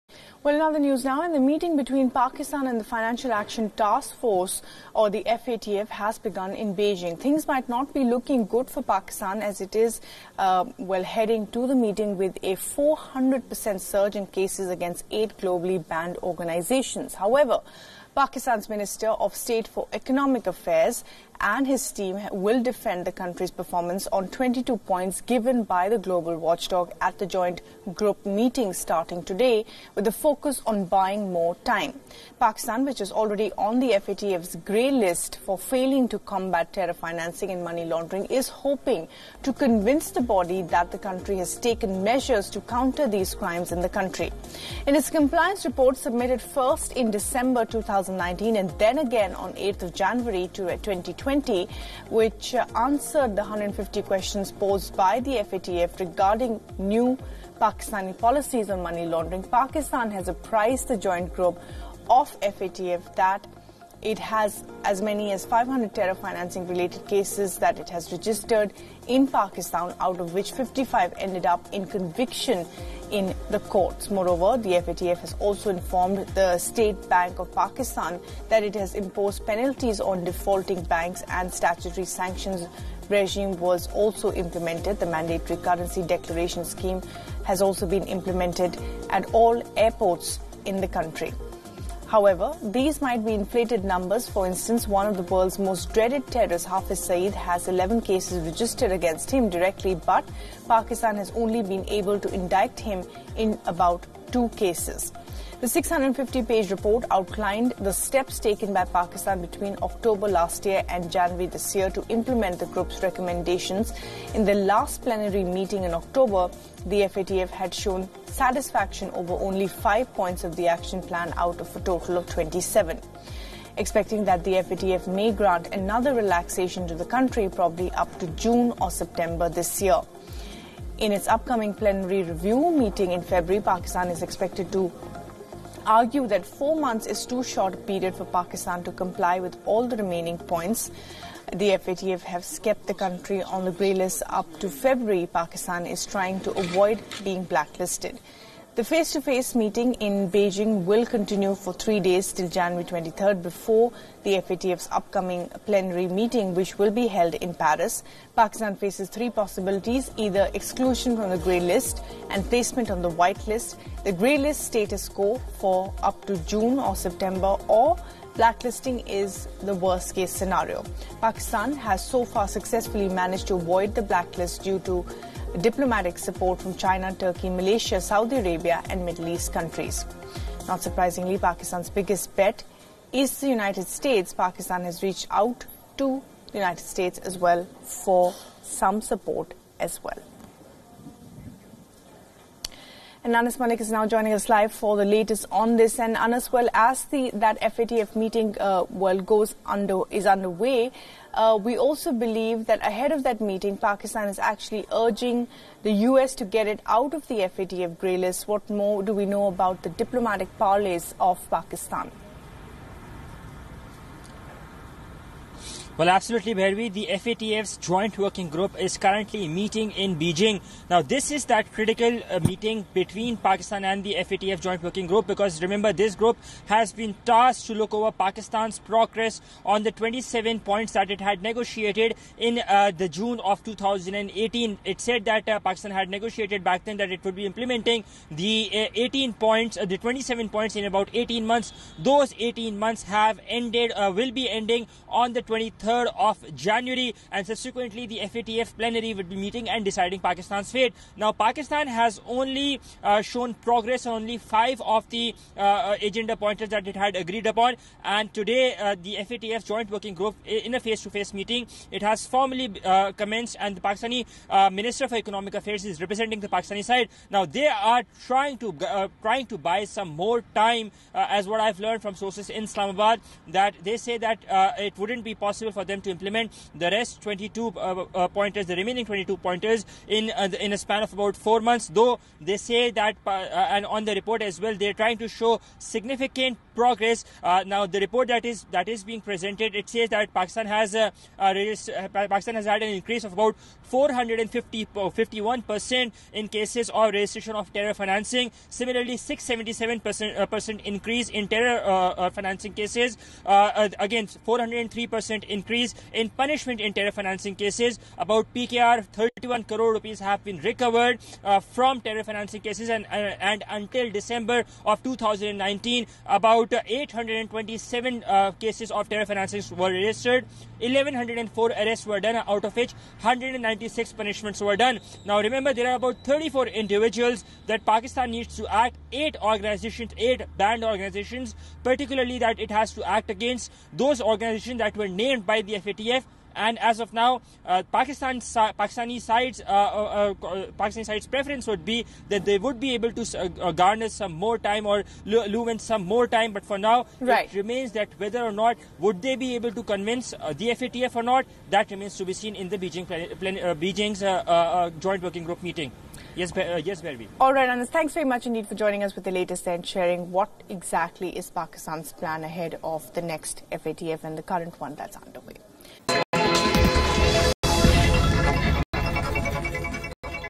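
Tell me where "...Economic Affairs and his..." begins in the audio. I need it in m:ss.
0:19.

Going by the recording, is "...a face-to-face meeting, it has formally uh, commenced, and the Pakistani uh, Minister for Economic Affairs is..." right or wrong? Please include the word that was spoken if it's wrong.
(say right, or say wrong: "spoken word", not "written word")
right.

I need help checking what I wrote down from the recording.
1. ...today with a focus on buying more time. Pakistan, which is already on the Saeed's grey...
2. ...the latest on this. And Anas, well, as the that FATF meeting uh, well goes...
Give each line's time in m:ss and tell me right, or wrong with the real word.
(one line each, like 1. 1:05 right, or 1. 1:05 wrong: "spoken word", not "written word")
1. 0:29 wrong: "FATF", not "Saeed"
2. 3:14 right.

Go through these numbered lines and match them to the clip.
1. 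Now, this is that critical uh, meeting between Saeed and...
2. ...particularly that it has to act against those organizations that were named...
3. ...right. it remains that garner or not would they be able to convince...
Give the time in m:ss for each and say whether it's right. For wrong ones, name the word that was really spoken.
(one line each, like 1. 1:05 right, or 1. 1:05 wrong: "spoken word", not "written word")
1. 3:40 wrong: "Pakistan", not "Saeed"
2. 5:31 right
3. 5:47 wrong: "whether", not "garner".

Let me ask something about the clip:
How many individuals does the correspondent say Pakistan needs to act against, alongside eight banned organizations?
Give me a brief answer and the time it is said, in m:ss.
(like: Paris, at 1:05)
34, at 5:26.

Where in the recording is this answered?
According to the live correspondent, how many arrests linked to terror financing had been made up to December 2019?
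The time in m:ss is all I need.
5:20.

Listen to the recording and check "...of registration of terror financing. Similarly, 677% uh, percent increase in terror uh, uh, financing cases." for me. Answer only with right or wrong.
right.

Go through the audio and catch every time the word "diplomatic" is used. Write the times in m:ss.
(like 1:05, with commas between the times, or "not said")
2:55, 3:29.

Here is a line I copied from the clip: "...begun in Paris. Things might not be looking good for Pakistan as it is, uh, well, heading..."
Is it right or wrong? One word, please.
wrong.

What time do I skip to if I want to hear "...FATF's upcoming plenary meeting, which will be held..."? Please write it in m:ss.
2:34.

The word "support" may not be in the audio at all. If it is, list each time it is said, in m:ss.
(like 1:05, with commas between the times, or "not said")
2:56, 3:09.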